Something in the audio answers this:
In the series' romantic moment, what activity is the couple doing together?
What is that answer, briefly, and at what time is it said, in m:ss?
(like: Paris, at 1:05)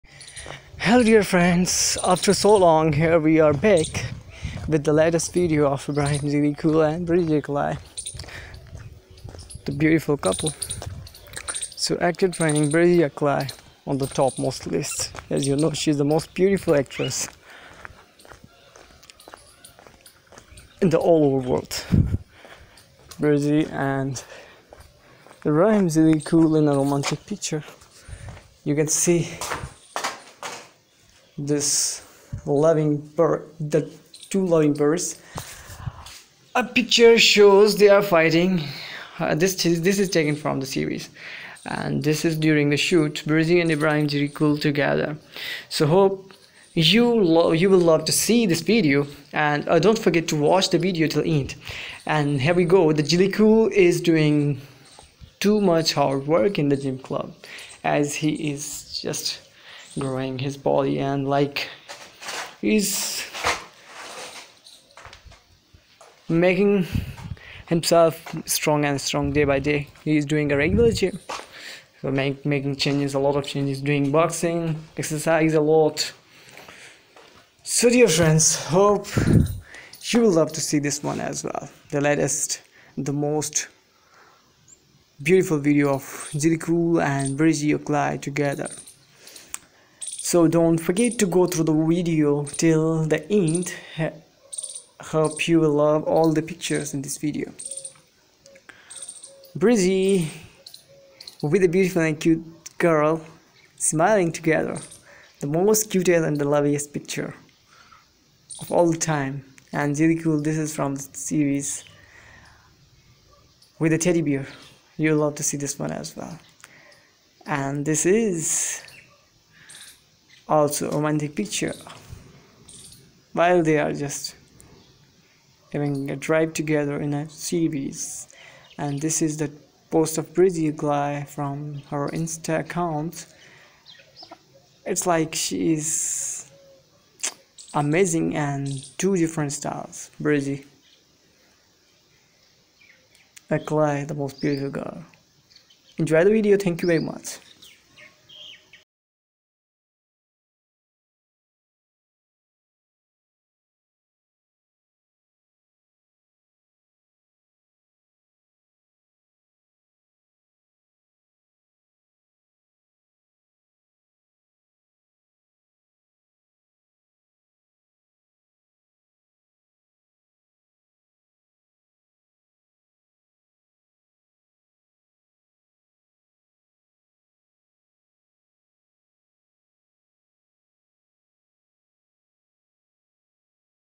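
Having a drive, at 2:05.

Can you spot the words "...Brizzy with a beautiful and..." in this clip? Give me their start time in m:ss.
1:39.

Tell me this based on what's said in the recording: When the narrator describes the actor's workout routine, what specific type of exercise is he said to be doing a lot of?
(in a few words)
Boxing.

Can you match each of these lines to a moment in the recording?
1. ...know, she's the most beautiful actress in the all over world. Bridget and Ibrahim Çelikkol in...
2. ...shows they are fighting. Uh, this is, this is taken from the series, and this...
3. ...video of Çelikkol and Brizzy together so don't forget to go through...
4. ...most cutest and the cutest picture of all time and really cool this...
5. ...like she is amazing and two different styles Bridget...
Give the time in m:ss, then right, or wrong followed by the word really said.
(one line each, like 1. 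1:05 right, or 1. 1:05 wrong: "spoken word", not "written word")
1. 0:15 right
2. 0:37 right
3. 1:25 right
4. 1:45 wrong: "loveliest", not "cutest"
5. 2:15 right.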